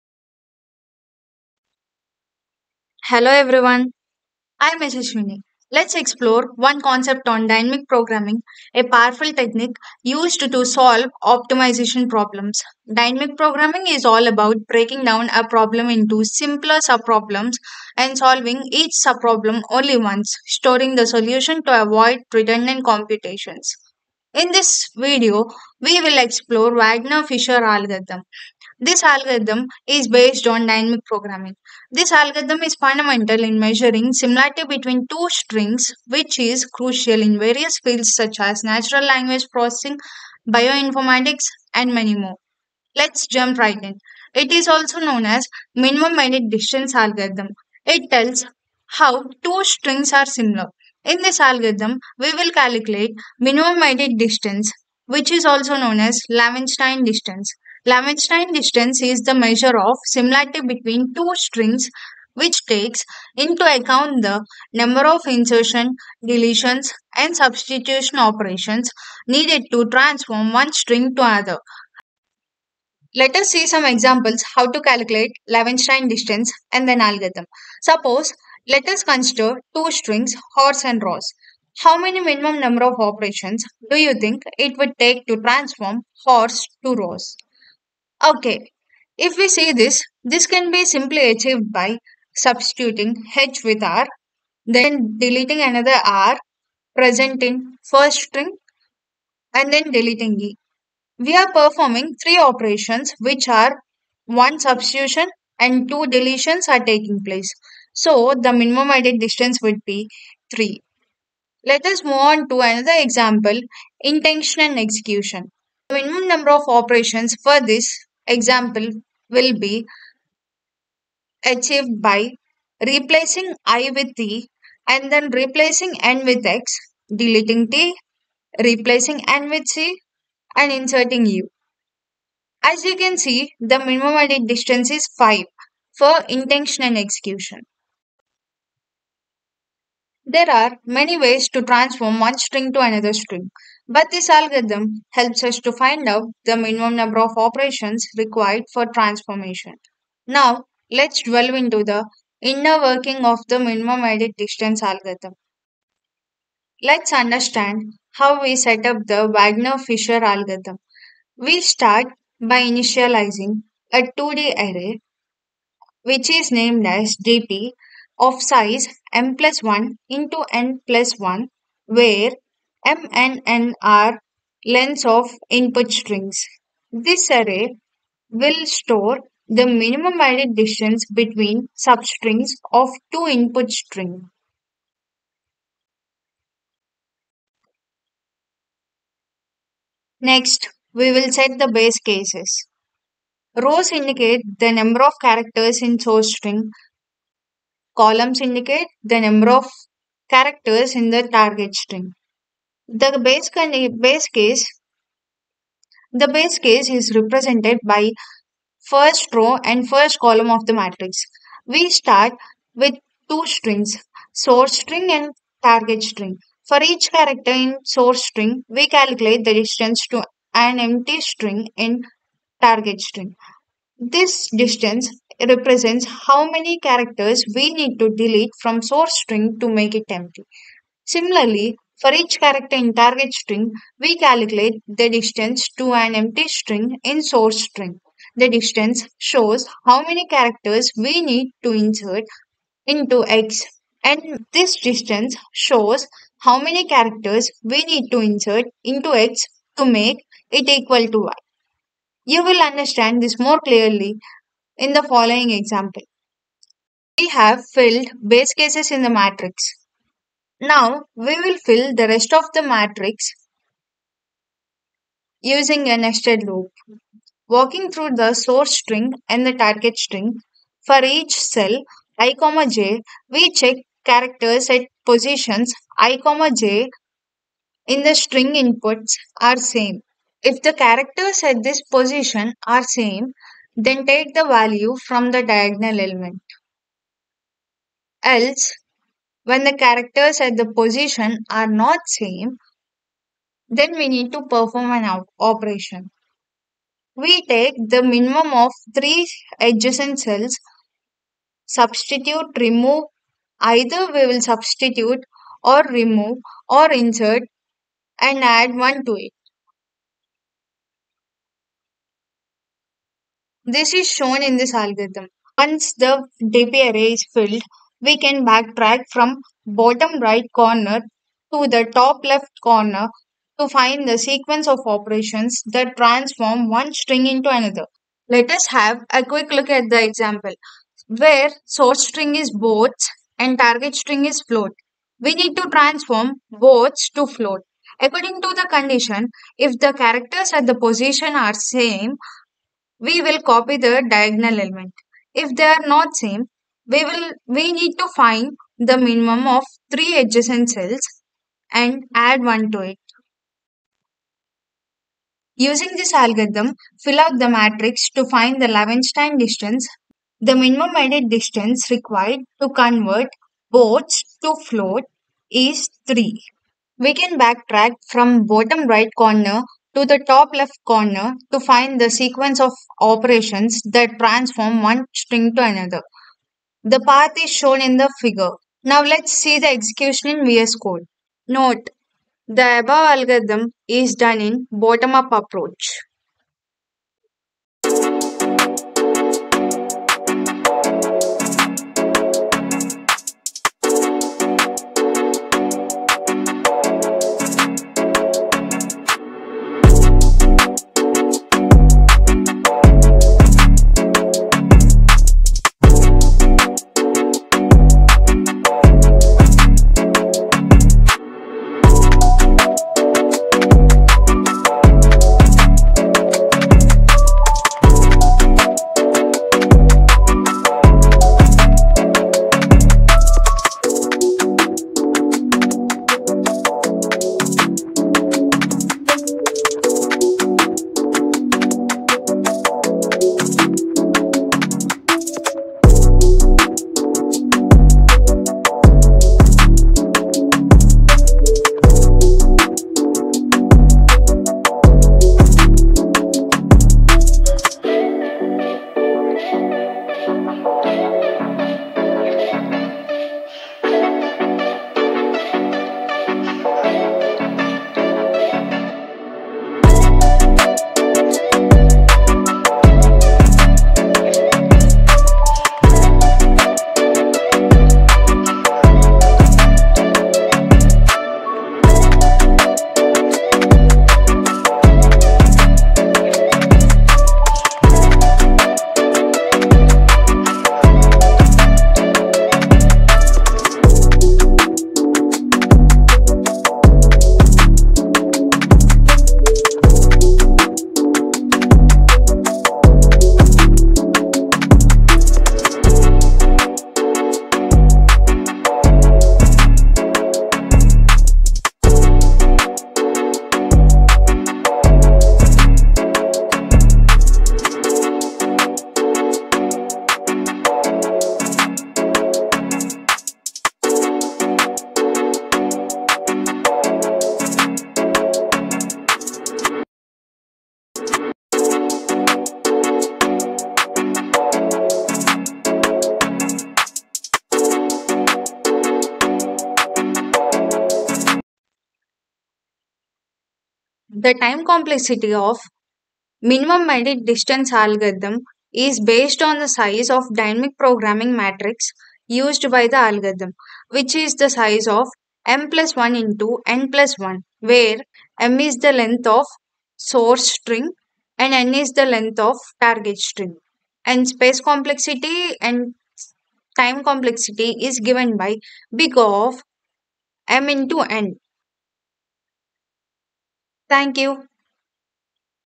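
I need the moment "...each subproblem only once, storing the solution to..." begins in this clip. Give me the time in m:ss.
0:18.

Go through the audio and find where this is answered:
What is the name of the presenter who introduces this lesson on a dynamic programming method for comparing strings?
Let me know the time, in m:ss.
0:04.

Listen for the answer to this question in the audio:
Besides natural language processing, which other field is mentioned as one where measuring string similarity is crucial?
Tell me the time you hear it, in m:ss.
0:40.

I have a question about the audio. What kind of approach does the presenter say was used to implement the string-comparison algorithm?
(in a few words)
bottom-up.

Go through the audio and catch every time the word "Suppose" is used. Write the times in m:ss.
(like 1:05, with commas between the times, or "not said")
1:17.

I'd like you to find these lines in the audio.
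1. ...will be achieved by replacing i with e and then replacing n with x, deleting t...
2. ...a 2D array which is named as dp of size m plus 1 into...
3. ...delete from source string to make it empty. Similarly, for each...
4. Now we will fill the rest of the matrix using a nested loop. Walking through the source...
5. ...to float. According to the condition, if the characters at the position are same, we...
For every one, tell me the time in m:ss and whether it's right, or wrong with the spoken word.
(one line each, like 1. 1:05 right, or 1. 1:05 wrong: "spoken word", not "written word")
1. 1:59 right
2. 2:43 right
3. 3:48 right
4. 4:20 right
5. 5:37 right.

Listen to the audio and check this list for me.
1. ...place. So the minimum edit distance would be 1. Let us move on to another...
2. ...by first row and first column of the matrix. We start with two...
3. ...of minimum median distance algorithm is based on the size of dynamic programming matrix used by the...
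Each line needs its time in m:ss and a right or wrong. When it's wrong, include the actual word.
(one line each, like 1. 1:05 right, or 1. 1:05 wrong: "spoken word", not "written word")
1. 1:47 wrong: "3", not "1"
2. 3:27 right
3. 8:55 right.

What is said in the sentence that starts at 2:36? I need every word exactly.
Let's understand how we set up the Wagner-Fischer algorithm.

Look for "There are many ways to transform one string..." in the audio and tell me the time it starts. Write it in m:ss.
2:20.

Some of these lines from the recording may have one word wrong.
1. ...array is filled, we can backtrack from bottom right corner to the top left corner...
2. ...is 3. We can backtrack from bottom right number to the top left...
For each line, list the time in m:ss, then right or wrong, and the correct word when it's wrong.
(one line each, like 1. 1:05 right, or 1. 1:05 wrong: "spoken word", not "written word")
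1. 5:16 right
2. 6:05 wrong: "corner", not "number".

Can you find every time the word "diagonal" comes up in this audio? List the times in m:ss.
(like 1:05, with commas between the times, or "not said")
4:45, 5:44.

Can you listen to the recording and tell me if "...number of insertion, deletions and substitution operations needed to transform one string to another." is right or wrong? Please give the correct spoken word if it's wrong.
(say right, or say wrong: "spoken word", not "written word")
right.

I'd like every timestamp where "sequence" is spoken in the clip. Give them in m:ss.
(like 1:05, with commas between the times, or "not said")
5:24, 6:12.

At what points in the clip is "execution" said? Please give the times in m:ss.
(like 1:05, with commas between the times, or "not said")
1:54, 2:16, 6:19.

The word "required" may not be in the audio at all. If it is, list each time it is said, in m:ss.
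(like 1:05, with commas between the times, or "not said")
2:28, 6:01.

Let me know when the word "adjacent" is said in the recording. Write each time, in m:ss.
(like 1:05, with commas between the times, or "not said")
4:59, 5:50.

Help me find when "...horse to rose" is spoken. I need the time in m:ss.
1:26.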